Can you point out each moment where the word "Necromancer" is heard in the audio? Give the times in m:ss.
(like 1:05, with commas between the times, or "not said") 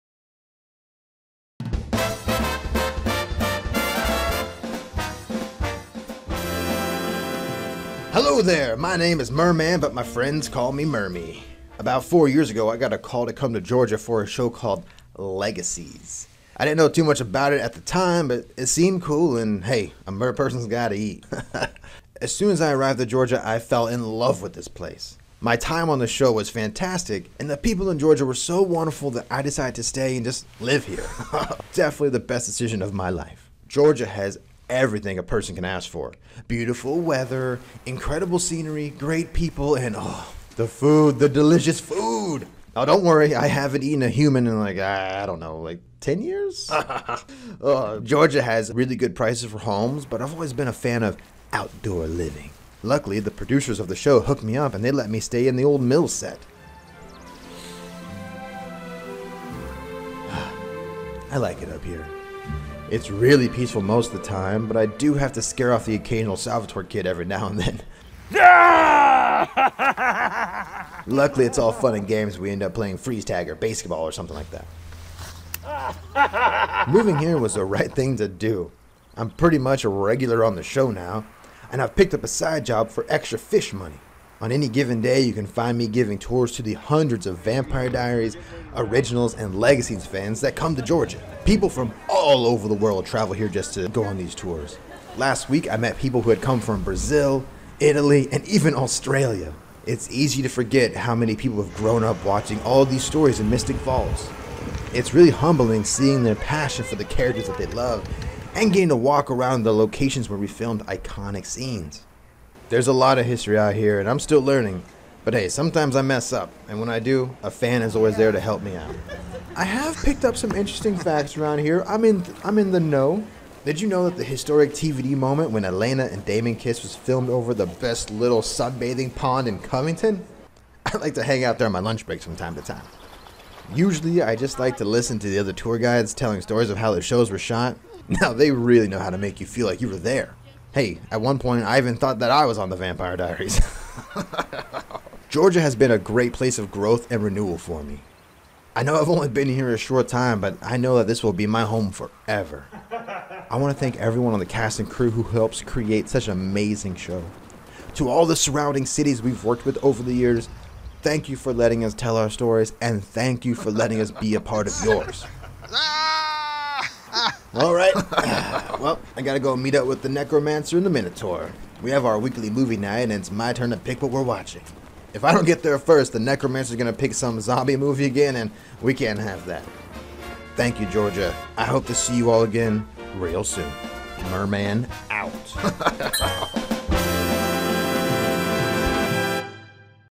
2:50, 2:56.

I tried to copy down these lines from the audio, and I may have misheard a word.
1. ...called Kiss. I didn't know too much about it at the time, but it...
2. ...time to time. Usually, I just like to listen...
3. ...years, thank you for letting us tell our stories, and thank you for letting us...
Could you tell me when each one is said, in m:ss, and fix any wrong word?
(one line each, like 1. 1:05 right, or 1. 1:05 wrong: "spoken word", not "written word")
1. 0:14 wrong: "Legacies", not "Kiss"
2. 2:12 right
3. 2:40 right.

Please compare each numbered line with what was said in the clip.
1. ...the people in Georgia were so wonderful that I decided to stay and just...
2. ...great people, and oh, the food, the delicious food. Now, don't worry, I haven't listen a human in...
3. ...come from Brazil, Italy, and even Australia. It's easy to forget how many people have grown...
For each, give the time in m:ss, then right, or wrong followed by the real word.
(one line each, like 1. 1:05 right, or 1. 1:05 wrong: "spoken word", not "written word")
1. 0:27 right
2. 0:38 wrong: "eaten", not "listen"
3. 1:36 right.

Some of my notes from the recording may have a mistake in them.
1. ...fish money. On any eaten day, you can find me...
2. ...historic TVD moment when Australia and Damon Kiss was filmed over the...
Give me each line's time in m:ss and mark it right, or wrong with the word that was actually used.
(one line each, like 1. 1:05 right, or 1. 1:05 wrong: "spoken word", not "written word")
1. 1:23 wrong: "given", not "eaten"
2. 2:04 wrong: "Elena", not "Australia".